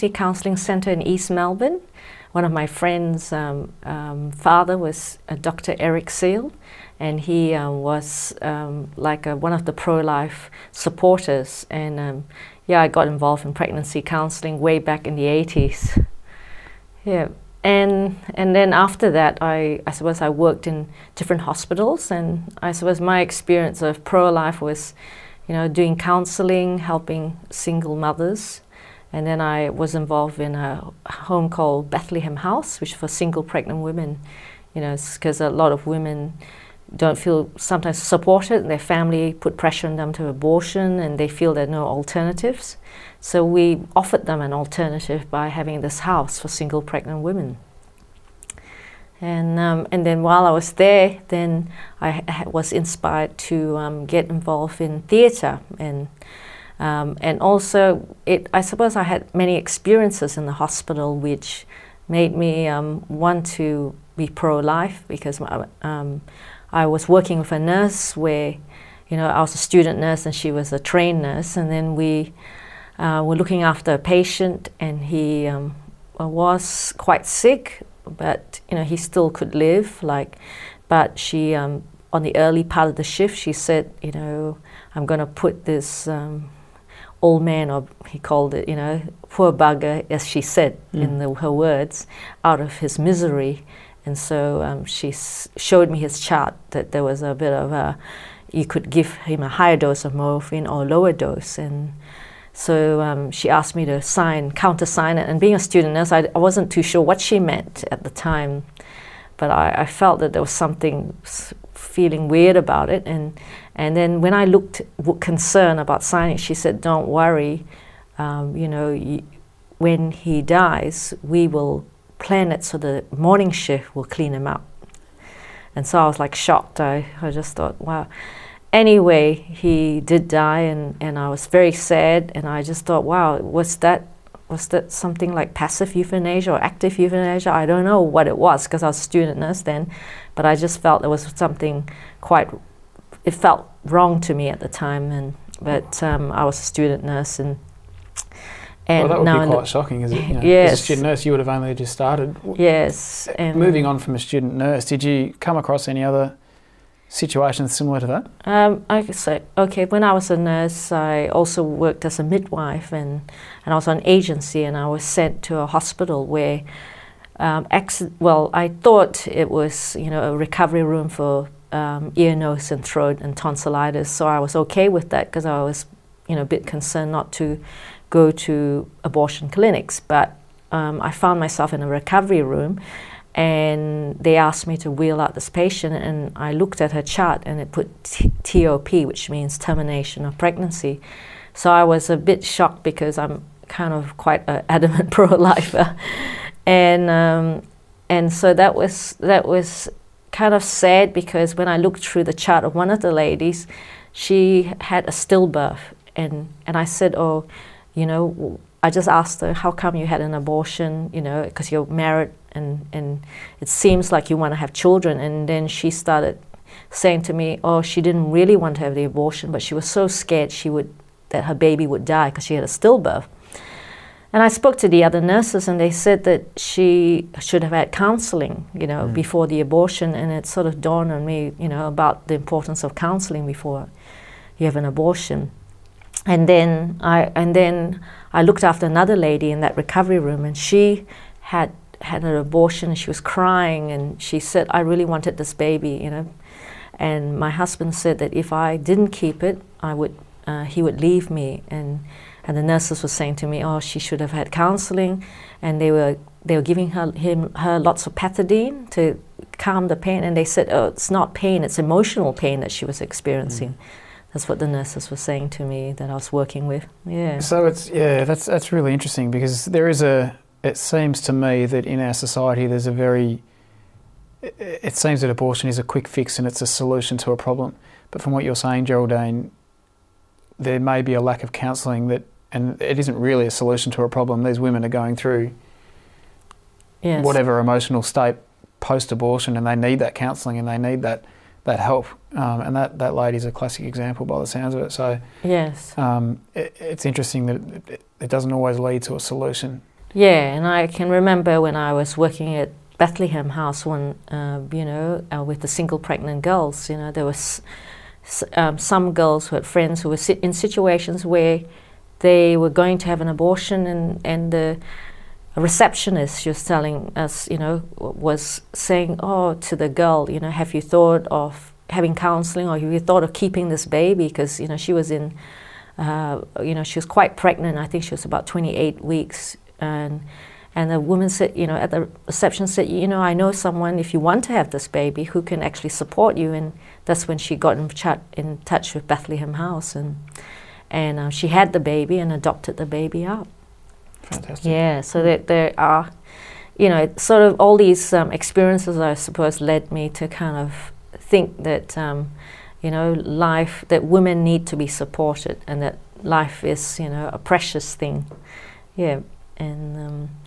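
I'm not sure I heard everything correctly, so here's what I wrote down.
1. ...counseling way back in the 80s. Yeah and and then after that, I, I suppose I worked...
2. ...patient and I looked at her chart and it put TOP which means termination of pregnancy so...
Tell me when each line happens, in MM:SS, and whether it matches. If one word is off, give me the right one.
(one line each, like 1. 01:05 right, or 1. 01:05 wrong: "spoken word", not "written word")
1. 00:14 right
2. 03:05 right.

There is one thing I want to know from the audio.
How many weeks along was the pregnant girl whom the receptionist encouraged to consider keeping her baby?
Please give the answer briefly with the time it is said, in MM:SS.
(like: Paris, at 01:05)
28, at 05:28.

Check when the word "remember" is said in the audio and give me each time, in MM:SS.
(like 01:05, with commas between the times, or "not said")
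05:01.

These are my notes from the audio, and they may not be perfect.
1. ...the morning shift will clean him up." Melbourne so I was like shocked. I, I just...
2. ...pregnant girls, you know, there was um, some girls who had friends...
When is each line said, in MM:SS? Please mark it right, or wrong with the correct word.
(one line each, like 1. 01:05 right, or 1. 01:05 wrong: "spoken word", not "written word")
1. 02:02 wrong: "And", not "Melbourne"
2. 05:05 right.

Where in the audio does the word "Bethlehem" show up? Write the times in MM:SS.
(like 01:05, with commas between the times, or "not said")
00:31, 05:02, 05:39.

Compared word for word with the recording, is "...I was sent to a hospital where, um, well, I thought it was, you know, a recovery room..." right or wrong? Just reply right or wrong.
right.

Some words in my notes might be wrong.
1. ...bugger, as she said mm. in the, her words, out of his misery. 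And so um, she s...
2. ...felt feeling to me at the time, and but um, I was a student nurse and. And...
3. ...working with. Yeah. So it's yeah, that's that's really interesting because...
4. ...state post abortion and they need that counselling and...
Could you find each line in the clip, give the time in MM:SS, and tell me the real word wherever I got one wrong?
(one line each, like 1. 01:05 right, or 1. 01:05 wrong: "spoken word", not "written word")
1. 01:29 right
2. 02:23 wrong: "wrong", not "feeling"
3. 04:26 right
4. 04:48 right.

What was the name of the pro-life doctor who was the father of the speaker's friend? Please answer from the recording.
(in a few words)
Dr. Eric Seal.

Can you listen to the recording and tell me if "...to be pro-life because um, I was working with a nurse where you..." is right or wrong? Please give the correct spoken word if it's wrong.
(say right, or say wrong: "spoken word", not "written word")
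right.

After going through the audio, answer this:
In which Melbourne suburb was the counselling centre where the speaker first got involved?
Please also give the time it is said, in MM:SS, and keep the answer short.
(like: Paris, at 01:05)
East Melbourne, at 00:01.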